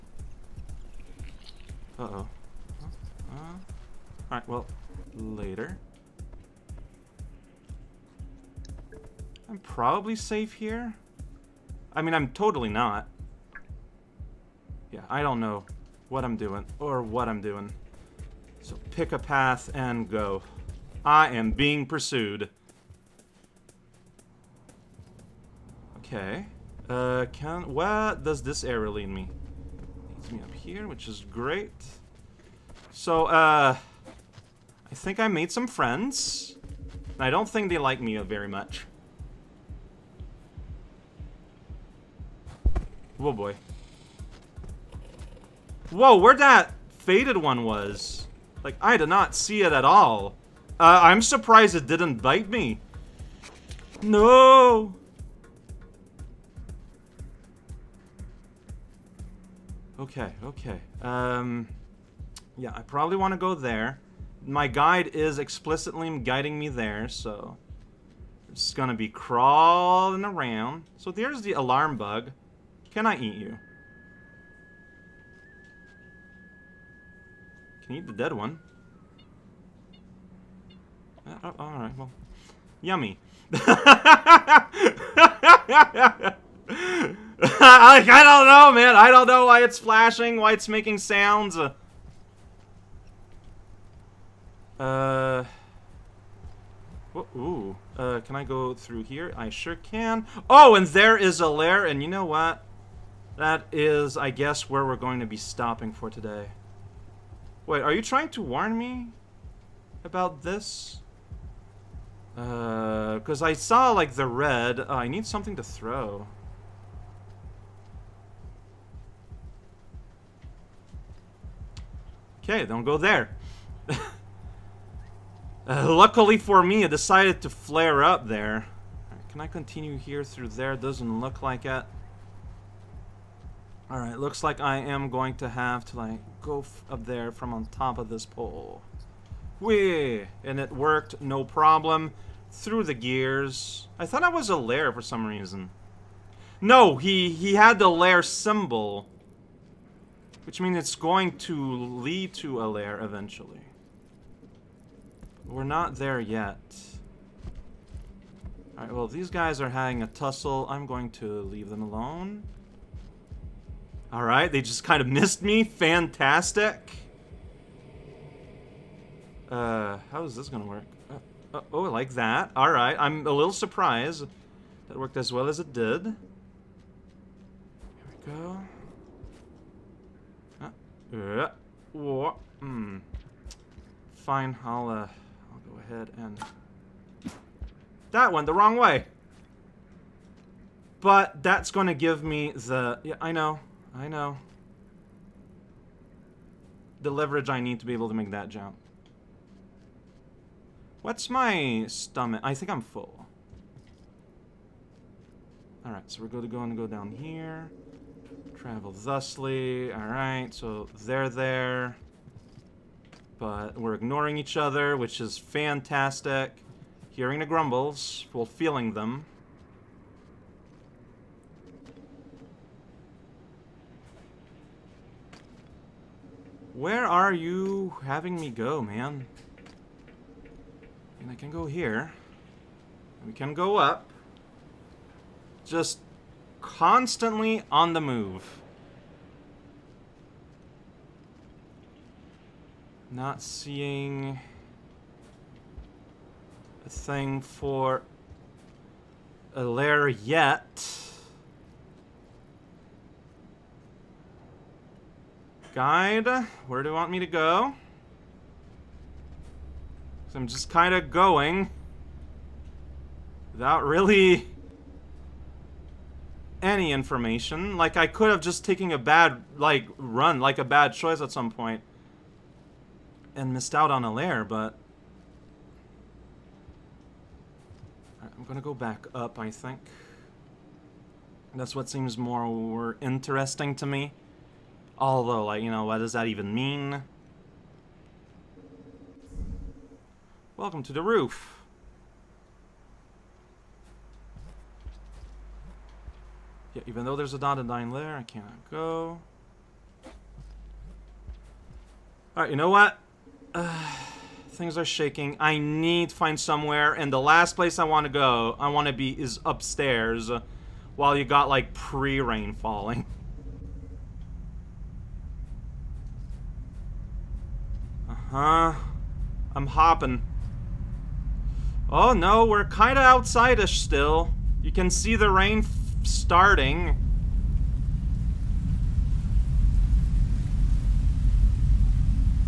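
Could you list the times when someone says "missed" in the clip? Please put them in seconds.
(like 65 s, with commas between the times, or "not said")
165 s, 273 s.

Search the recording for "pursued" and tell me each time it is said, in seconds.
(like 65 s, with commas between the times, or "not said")
21 s.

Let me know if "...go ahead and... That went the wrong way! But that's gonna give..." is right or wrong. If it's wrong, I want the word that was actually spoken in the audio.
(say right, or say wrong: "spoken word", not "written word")
right.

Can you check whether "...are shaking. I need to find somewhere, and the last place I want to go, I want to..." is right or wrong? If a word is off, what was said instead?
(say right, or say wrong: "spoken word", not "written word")
right.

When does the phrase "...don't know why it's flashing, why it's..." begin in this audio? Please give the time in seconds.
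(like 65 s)
89 s.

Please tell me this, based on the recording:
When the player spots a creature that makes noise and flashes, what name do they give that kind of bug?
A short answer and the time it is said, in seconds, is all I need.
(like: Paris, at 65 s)
alarm bug, at 71 s.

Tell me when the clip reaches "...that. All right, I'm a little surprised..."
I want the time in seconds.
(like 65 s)
172 s.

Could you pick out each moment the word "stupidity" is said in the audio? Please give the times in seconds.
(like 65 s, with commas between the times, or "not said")
not said.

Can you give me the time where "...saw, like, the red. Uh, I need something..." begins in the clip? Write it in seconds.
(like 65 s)
113 s.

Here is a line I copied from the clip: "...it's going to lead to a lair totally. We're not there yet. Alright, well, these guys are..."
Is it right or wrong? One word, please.
wrong.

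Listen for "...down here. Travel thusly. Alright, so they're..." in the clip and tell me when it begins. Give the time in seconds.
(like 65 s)
206 s.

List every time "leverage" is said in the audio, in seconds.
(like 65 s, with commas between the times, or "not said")
197 s.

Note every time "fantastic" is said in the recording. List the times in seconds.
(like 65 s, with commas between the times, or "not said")
165 s, 215 s.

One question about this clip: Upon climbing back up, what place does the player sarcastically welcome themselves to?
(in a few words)
the roof.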